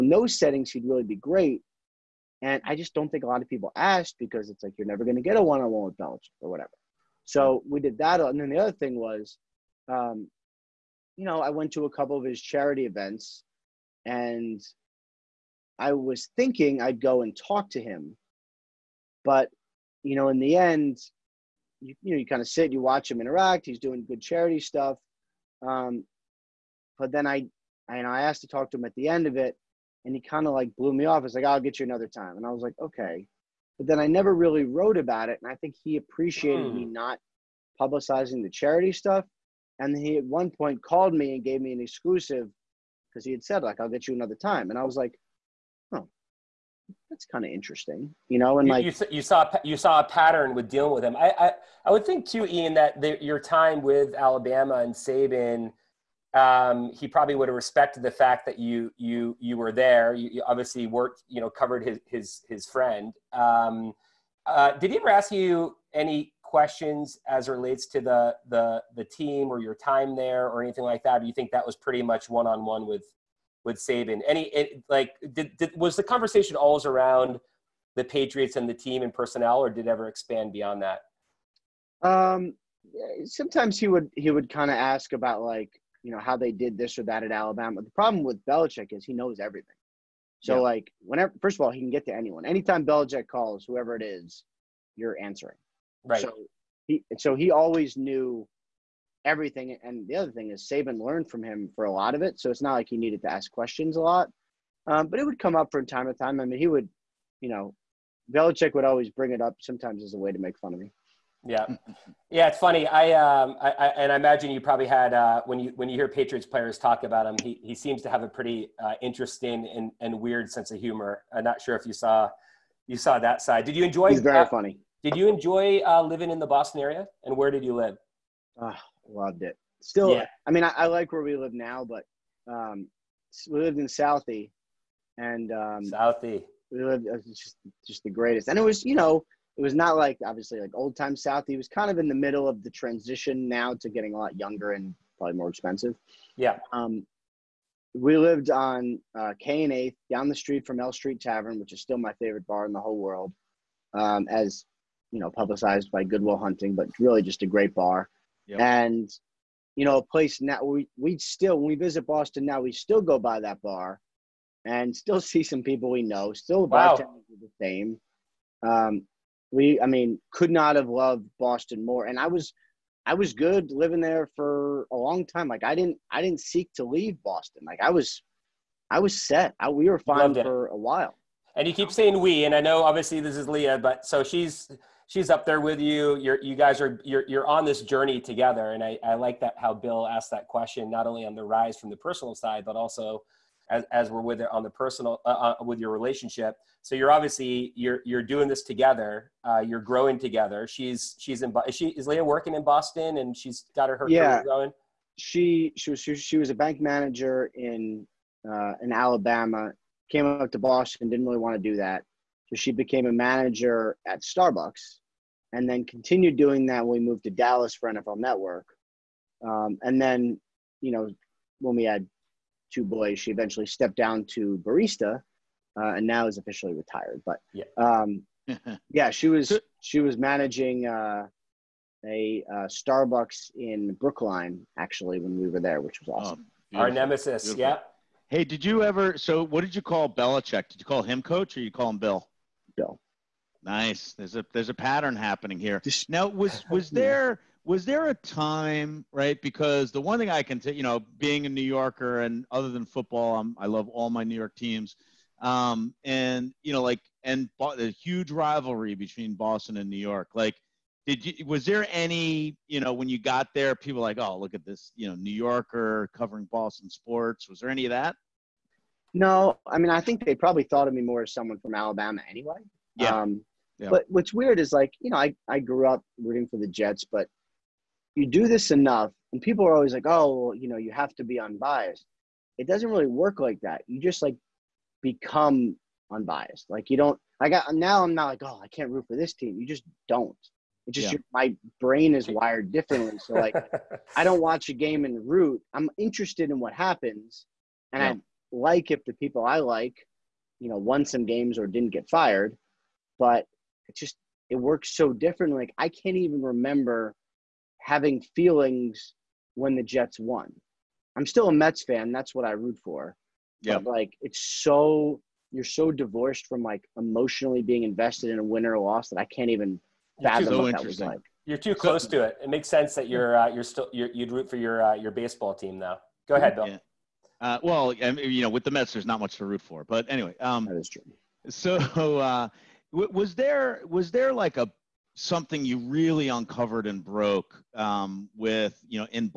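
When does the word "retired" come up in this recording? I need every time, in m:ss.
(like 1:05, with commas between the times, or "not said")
3:46.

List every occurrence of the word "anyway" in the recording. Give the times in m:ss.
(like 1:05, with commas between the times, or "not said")
4:32, 5:30.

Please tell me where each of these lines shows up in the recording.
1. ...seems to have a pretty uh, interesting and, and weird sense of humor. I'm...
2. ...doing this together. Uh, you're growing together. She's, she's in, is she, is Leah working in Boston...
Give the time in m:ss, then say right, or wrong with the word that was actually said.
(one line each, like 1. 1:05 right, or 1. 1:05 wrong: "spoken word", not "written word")
1. 1:57 right
2. 3:18 right.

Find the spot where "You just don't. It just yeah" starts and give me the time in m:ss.
4:49.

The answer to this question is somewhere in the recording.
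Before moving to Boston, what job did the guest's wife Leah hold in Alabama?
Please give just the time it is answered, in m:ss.
3:26.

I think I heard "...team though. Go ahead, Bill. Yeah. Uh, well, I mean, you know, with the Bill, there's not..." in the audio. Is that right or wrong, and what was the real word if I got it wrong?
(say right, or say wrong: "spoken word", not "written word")
wrong: "Mets", not "Bill".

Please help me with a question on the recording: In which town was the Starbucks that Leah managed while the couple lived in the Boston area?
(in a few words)
Brookline.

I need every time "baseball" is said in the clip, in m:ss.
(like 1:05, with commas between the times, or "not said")
5:25.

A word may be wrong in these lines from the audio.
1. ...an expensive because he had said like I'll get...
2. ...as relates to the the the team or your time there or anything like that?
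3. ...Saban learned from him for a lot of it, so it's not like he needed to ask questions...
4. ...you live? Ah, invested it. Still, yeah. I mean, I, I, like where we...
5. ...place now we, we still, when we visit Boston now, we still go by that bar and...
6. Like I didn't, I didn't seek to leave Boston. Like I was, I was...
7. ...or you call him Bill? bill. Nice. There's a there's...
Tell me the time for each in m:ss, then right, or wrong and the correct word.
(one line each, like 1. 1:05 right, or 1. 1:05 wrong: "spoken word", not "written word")
1. 0:41 wrong: "exclusive", not "expensive"
2. 1:07 right
3. 1:40 right
4. 2:07 wrong: "loved", not "invested"
5. 2:40 right
6. 2:55 right
7. 4:01 right.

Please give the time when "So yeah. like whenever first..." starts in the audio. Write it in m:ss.
1:30.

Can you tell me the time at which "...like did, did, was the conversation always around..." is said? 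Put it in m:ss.
1:14.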